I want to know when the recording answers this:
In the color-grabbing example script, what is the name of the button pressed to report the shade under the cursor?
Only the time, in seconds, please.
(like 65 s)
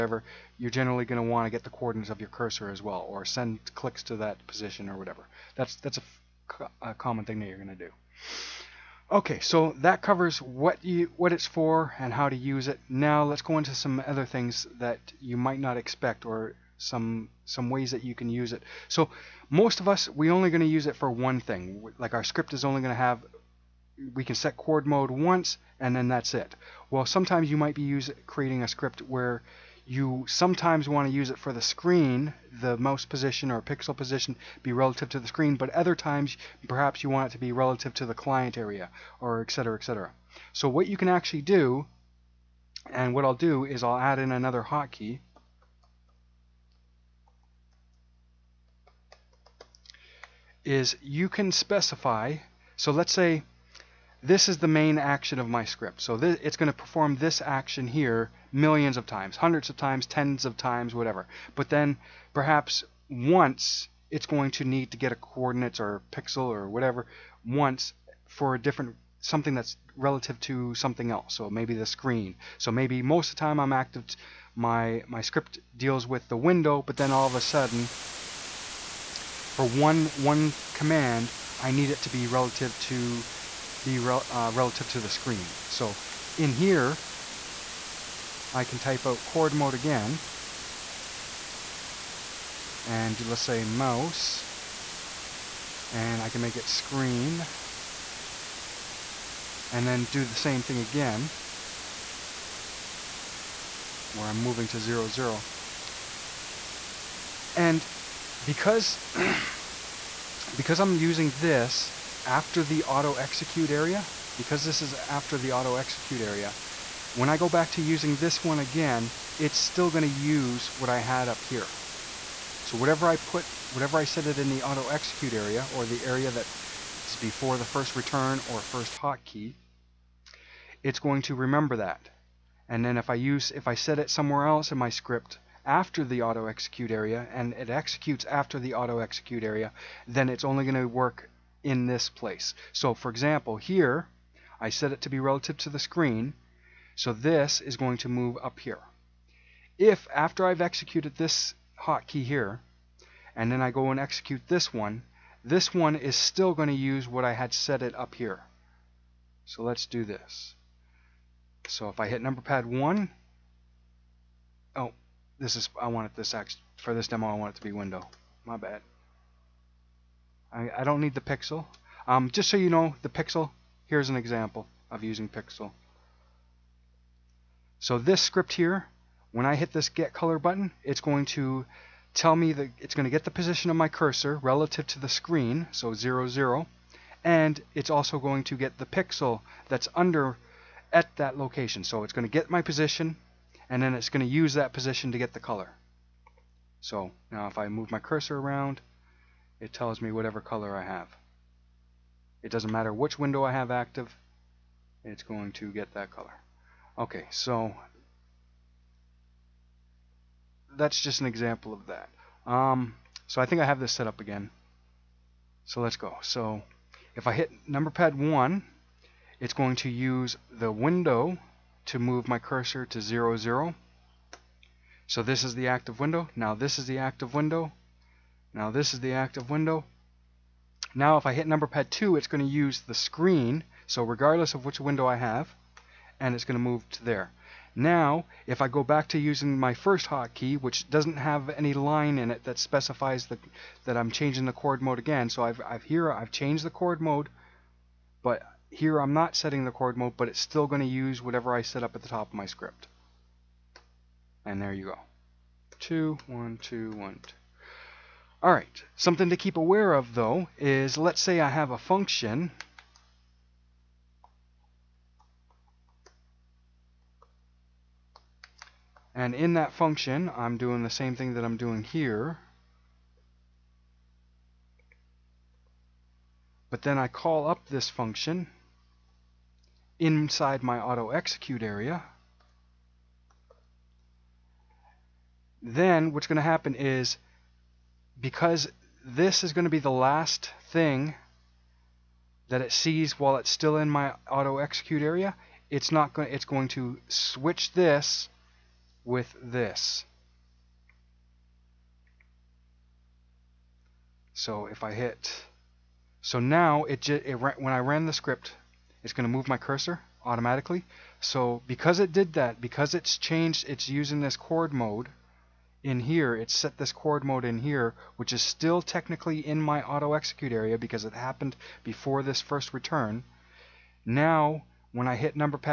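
179 s.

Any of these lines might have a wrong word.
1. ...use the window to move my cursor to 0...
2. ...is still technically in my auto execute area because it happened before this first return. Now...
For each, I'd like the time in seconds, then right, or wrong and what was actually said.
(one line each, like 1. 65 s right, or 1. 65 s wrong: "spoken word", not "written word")
1. 219 s right
2. 318 s right.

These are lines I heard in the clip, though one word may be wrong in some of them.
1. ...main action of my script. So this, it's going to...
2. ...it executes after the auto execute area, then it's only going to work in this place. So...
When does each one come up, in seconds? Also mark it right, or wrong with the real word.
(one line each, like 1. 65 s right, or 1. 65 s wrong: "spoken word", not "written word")
1. 54 s right
2. 137 s right.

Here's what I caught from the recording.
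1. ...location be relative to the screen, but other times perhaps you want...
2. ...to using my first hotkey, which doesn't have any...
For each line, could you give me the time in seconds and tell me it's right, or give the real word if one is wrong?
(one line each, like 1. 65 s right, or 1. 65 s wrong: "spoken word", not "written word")
1. 33 s wrong: "position", not "location"
2. 239 s right.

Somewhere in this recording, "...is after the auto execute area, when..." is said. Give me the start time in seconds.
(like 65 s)
114 s.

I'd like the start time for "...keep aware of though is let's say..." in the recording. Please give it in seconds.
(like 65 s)
259 s.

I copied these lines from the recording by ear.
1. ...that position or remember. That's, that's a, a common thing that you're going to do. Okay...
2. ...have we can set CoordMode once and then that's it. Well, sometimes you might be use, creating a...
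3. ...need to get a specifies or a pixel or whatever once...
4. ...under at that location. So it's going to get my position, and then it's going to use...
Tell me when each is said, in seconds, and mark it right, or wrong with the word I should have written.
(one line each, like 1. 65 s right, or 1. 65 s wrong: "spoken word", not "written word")
1. 4 s wrong: "whatever", not "remember"
2. 22 s right
3. 64 s wrong: "coordinates", not "specifies"
4. 189 s right.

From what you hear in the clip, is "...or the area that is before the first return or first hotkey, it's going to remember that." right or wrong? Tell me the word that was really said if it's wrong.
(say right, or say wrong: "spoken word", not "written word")
right.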